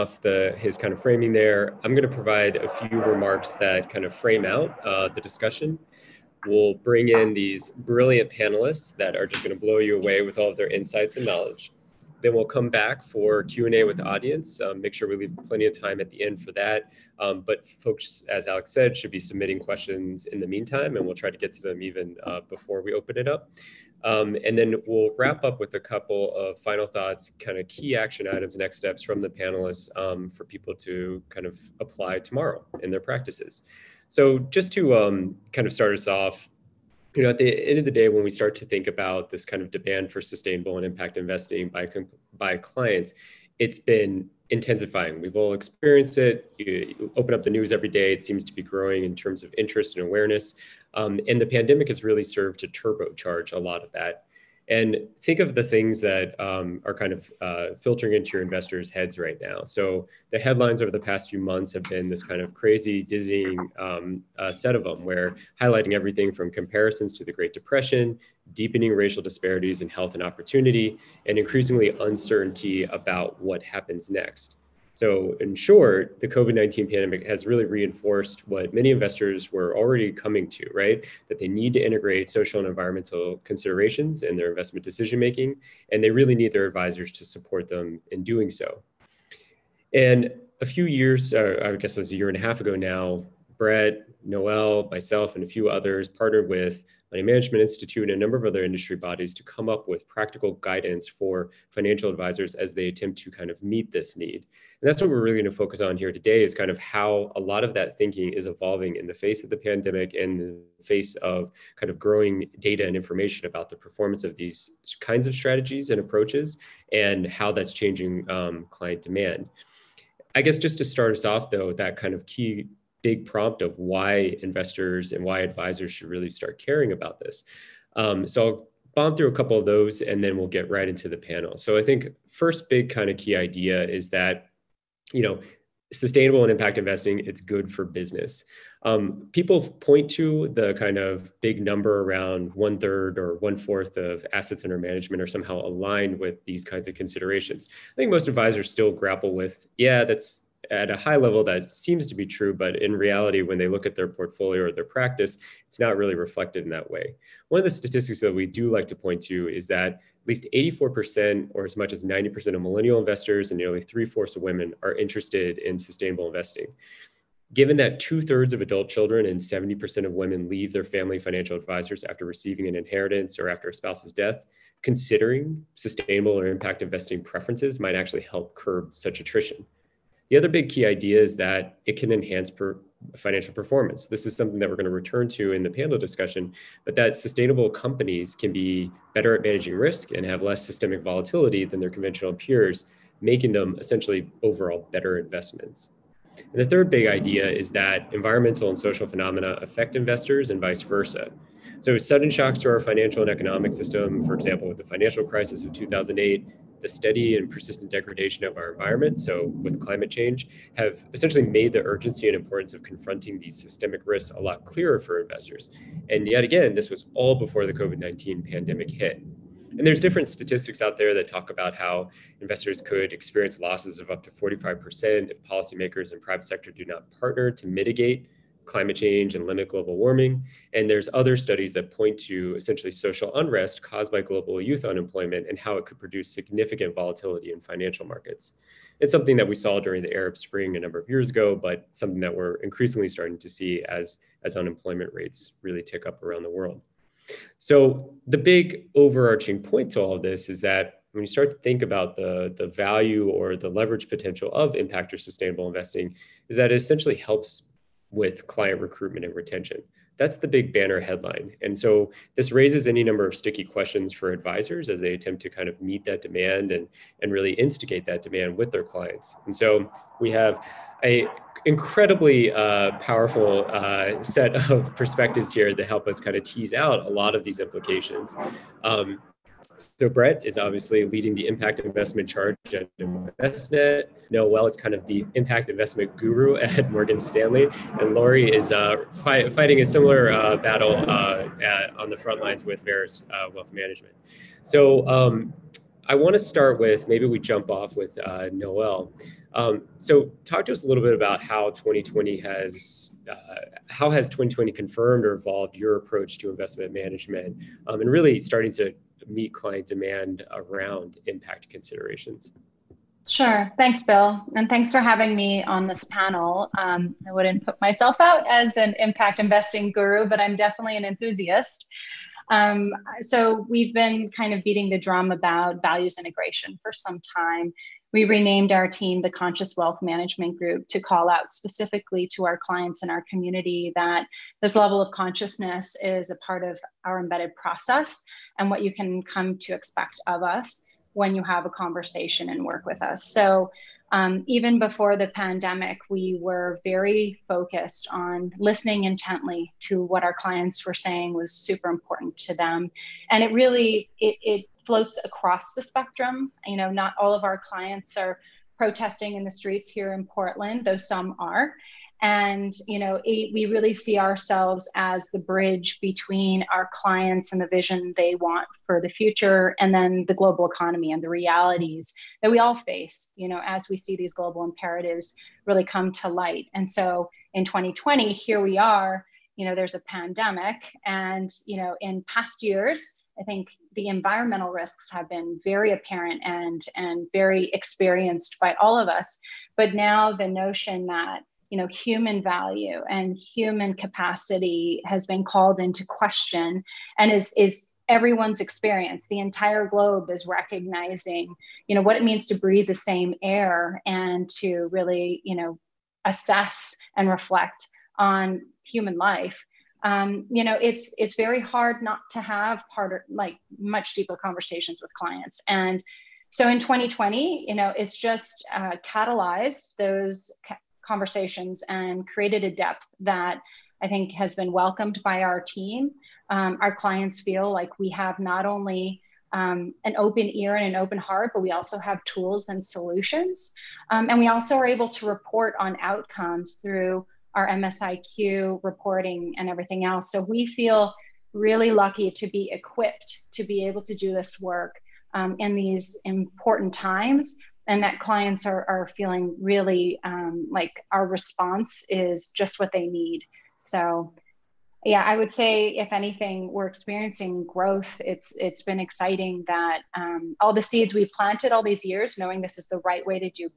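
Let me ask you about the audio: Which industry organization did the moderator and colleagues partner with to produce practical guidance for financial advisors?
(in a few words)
Money Management Institute.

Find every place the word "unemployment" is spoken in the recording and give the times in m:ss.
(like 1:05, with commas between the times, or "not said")
3:54, 4:04.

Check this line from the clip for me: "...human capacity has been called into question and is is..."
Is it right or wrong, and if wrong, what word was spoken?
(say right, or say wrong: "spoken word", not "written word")
right.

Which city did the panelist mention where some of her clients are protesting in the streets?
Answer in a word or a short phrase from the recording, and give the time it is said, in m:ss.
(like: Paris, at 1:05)
Portland, at 6:00.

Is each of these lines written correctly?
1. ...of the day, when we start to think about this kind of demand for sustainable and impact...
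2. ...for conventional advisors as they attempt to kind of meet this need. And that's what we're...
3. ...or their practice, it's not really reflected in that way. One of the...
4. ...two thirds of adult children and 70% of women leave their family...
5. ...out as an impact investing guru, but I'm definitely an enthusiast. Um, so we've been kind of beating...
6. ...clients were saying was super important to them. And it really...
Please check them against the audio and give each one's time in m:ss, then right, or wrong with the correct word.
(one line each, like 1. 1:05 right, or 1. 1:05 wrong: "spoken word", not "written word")
1. 0:37 right
2. 1:41 wrong: "financial", not "conventional"
3. 2:34 right
4. 2:47 right
5. 5:18 right
6. 5:50 right.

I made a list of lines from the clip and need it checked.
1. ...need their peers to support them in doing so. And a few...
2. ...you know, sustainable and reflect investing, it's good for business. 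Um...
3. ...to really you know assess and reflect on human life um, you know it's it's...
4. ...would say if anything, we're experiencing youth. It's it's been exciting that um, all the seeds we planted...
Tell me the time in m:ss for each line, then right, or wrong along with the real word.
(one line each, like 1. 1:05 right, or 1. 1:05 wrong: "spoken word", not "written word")
1. 1:26 wrong: "advisors", not "peers"
2. 2:15 wrong: "impact", not "reflect"
3. 6:44 right
4. 7:35 wrong: "growth", not "youth".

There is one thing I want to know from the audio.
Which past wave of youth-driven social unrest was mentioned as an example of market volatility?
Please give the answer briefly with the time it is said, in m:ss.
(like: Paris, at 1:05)
Arab Spring, at 4:00.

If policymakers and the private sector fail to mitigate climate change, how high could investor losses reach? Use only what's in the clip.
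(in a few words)
45%.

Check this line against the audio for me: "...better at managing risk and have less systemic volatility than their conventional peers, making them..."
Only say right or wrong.
right.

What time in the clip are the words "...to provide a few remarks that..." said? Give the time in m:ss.
0:02.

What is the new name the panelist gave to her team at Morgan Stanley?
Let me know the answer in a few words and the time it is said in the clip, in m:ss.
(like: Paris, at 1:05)
Conscious Wealth Management Group, at 5:29.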